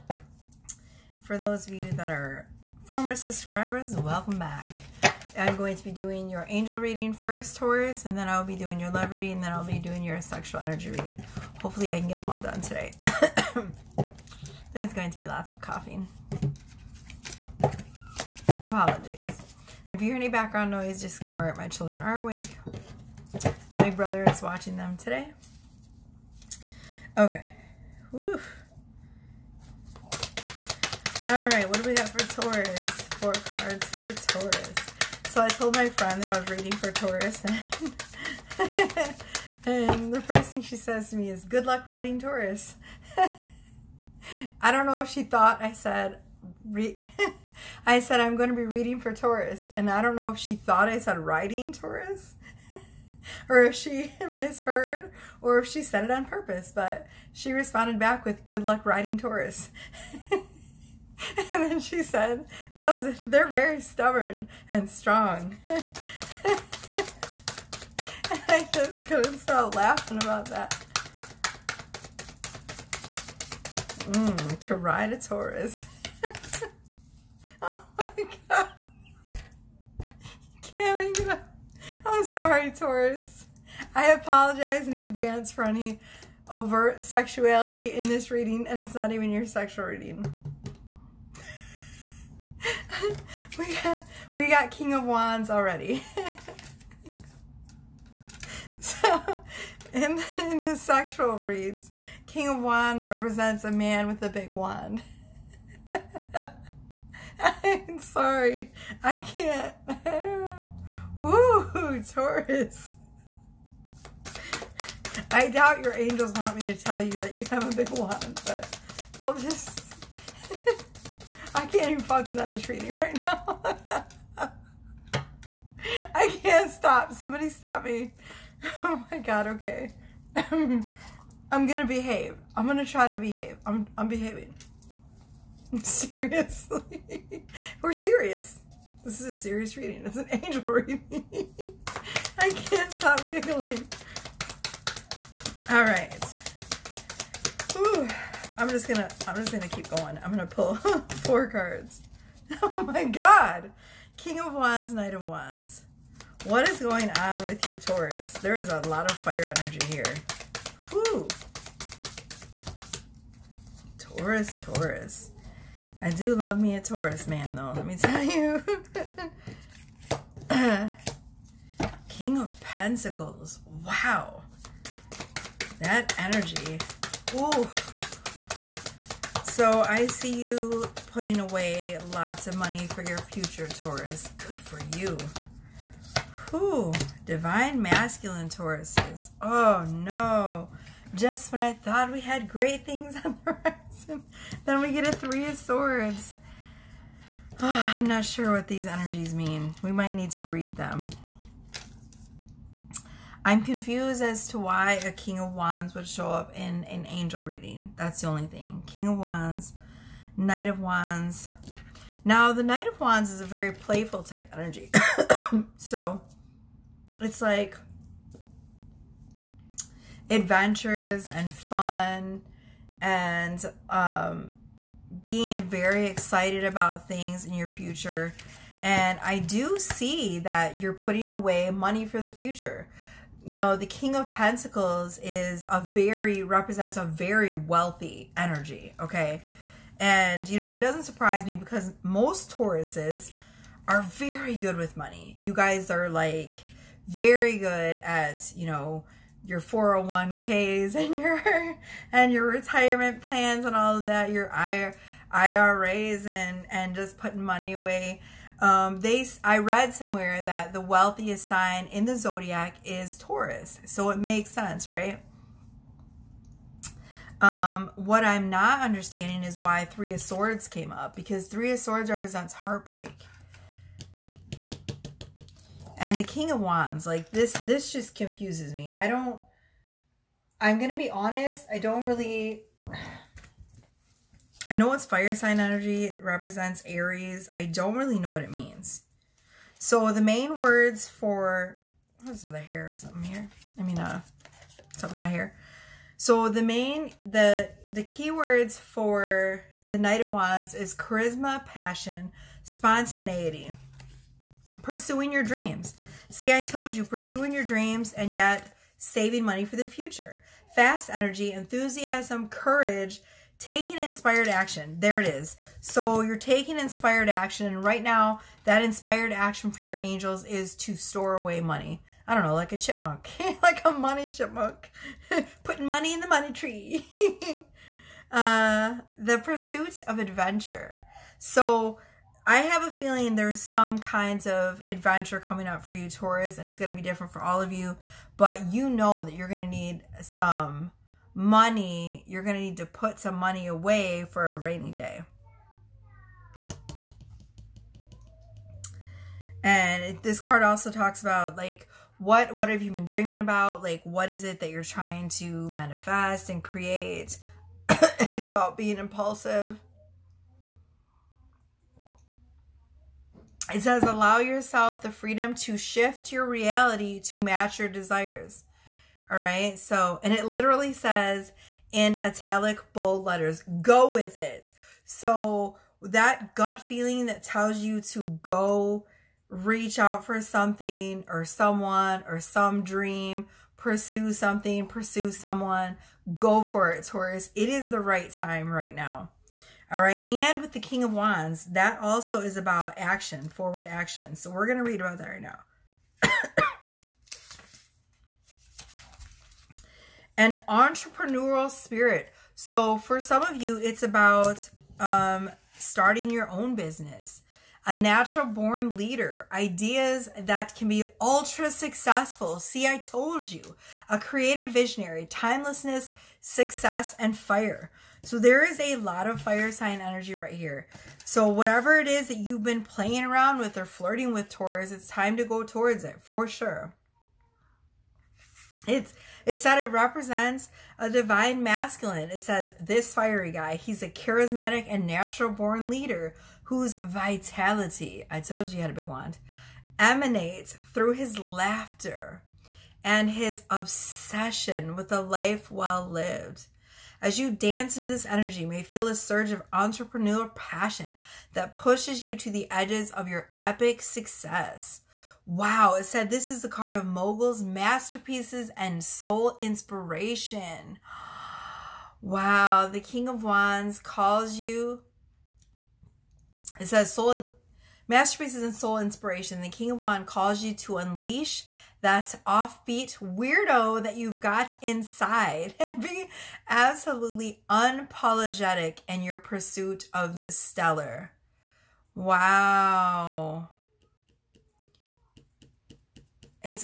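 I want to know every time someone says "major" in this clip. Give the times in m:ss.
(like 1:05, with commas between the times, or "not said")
not said.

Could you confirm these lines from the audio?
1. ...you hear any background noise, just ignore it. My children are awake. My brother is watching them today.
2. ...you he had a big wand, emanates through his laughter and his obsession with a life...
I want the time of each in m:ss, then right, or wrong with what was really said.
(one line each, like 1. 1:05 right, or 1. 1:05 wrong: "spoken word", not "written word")
1. 0:20 right
2. 7:18 right.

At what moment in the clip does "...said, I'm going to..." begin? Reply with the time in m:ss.
0:47.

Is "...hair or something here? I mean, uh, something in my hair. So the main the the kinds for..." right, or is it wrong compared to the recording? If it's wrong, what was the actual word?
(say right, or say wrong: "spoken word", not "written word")
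wrong: "keywords", not "kinds".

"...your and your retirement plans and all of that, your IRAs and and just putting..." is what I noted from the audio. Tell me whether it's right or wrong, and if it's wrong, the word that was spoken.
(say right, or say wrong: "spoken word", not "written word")
right.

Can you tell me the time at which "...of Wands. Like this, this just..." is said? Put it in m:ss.
4:36.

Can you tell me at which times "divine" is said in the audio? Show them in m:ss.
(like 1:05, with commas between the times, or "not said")
3:07, 7:11.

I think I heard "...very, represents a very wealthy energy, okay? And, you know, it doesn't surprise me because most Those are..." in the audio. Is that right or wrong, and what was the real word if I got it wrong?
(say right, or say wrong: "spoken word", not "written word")
wrong: "Tauruses", not "Those".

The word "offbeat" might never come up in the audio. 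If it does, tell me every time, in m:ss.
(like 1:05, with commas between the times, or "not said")
7:52.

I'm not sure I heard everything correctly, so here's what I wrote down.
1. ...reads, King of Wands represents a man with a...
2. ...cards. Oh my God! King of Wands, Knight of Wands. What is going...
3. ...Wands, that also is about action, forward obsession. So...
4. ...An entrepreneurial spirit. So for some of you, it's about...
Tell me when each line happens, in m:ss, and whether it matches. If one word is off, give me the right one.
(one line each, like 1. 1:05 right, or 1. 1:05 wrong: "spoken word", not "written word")
1. 1:41 right
2. 2:31 right
3. 6:31 wrong: "action", not "obsession"
4. 6:40 right.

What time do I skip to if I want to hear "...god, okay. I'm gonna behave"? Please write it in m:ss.
2:09.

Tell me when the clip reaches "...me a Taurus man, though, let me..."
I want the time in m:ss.
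2:46.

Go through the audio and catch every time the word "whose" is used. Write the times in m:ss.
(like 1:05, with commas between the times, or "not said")
7:16.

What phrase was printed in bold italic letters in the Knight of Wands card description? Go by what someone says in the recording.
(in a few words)
Go with it.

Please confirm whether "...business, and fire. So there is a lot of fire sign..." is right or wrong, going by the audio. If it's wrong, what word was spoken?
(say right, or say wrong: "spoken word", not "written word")
wrong: "success", not "business".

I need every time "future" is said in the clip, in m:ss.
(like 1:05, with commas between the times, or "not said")
3:03, 3:47, 3:52, 5:09.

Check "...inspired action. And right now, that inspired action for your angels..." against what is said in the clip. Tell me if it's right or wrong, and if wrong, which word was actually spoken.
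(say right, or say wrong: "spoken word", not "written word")
right.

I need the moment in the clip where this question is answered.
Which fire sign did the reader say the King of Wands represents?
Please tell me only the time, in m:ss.
4:46.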